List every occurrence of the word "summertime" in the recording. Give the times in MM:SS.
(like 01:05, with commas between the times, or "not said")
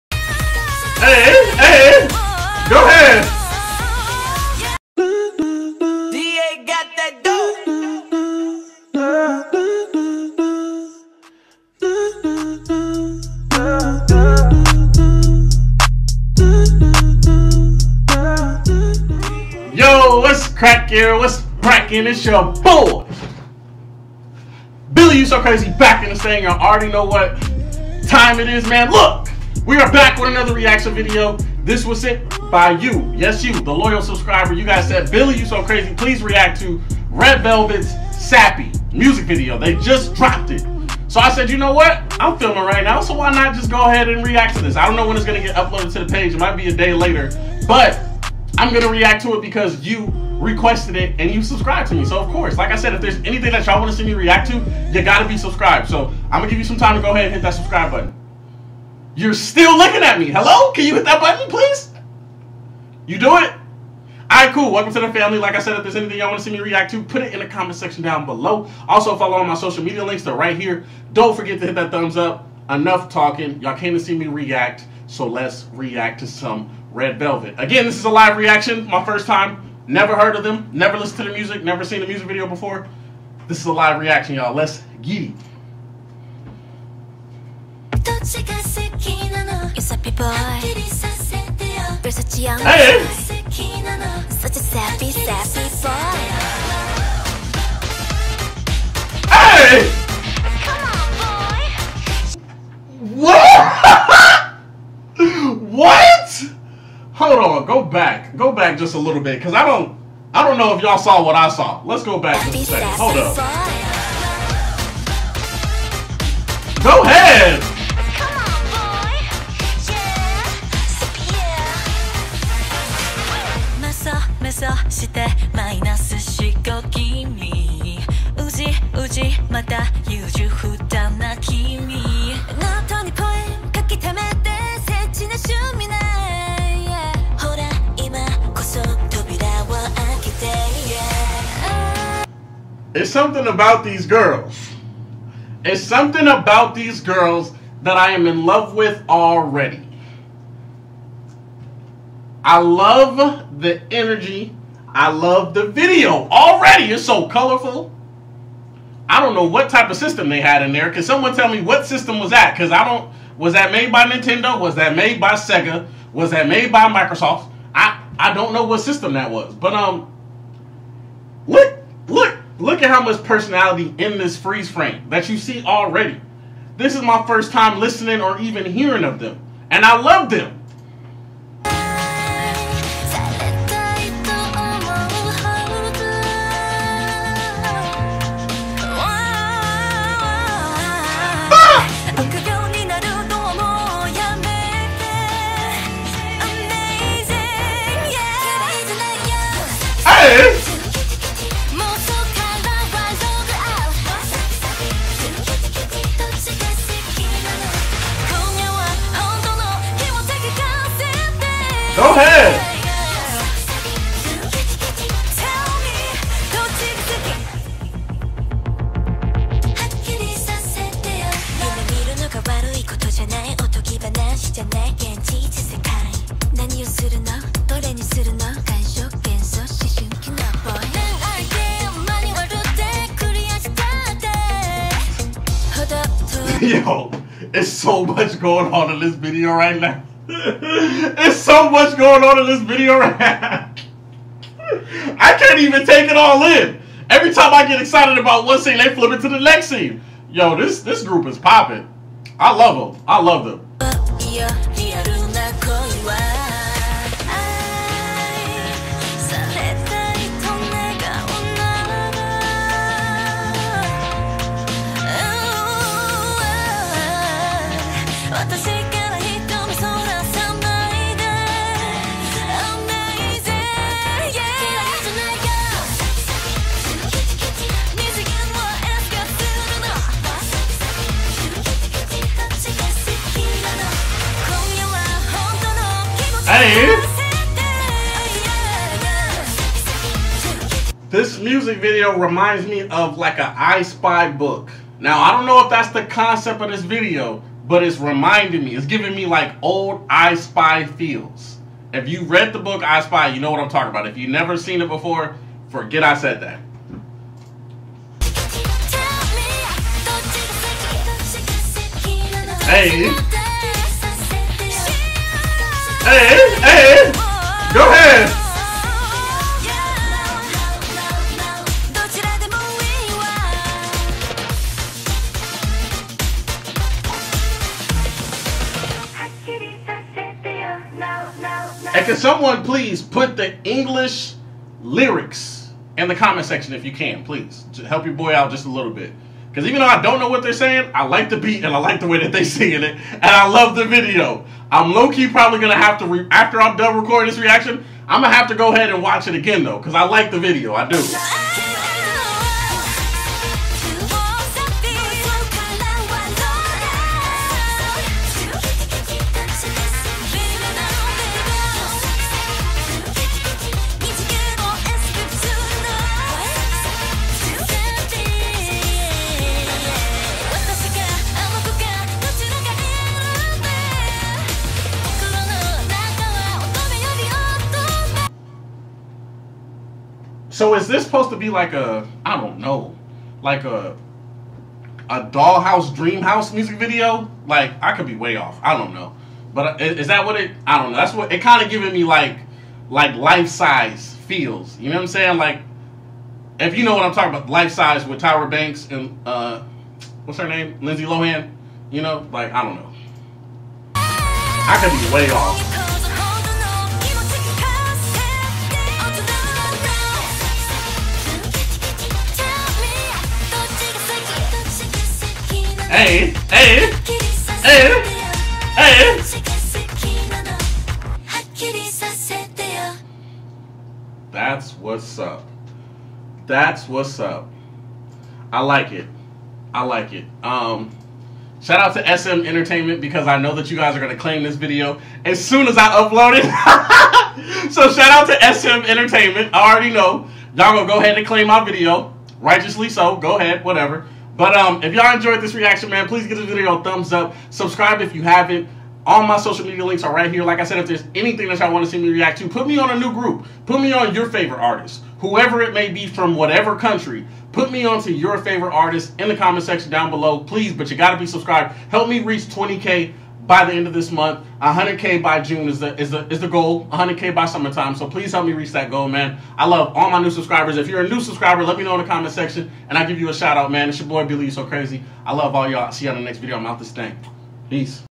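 07:47.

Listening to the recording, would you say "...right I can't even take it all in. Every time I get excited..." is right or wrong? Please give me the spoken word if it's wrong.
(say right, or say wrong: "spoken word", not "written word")
right.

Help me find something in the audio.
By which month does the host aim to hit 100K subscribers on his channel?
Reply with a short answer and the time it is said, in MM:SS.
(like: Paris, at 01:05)
June, at 07:45.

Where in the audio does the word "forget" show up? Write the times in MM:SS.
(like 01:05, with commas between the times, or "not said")
01:11, 05:05.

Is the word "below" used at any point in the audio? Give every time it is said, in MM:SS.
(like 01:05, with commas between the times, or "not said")
01:08, 07:40.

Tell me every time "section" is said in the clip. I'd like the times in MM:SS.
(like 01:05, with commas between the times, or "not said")
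01:07, 05:36, 07:39, 07:52.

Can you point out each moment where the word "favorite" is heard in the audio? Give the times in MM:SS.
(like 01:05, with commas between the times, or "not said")
07:34, 07:38.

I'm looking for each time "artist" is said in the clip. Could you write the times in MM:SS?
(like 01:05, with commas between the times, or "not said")
07:34, 07:38.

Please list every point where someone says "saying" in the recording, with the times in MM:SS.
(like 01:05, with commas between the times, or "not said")
05:40, 06:35.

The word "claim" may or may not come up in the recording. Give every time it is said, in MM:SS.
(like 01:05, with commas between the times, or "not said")
07:14, 07:21.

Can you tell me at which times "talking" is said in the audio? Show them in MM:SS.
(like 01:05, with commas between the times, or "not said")
01:13, 05:03, 06:37.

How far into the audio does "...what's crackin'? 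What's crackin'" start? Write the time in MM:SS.
00:20.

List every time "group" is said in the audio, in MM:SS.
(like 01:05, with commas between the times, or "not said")
04:11, 07:33.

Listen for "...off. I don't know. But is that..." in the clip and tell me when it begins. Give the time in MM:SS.
06:28.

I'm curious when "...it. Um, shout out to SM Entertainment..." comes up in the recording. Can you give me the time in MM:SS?
07:10.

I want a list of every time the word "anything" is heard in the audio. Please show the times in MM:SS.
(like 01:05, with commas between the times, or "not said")
00:53, 01:05, 07:31.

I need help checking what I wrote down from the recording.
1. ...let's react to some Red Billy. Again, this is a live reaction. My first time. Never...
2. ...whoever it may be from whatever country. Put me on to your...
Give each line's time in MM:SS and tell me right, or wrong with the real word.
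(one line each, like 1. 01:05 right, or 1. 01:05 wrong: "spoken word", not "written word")
1. 01:15 wrong: "Velvet", not "Billy"
2. 07:35 right.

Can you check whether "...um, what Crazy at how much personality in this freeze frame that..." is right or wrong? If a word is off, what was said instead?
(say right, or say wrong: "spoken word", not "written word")
wrong: "Look", not "Crazy".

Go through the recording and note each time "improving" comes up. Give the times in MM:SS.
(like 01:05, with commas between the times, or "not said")
not said.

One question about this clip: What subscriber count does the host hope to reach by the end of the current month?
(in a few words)
20K.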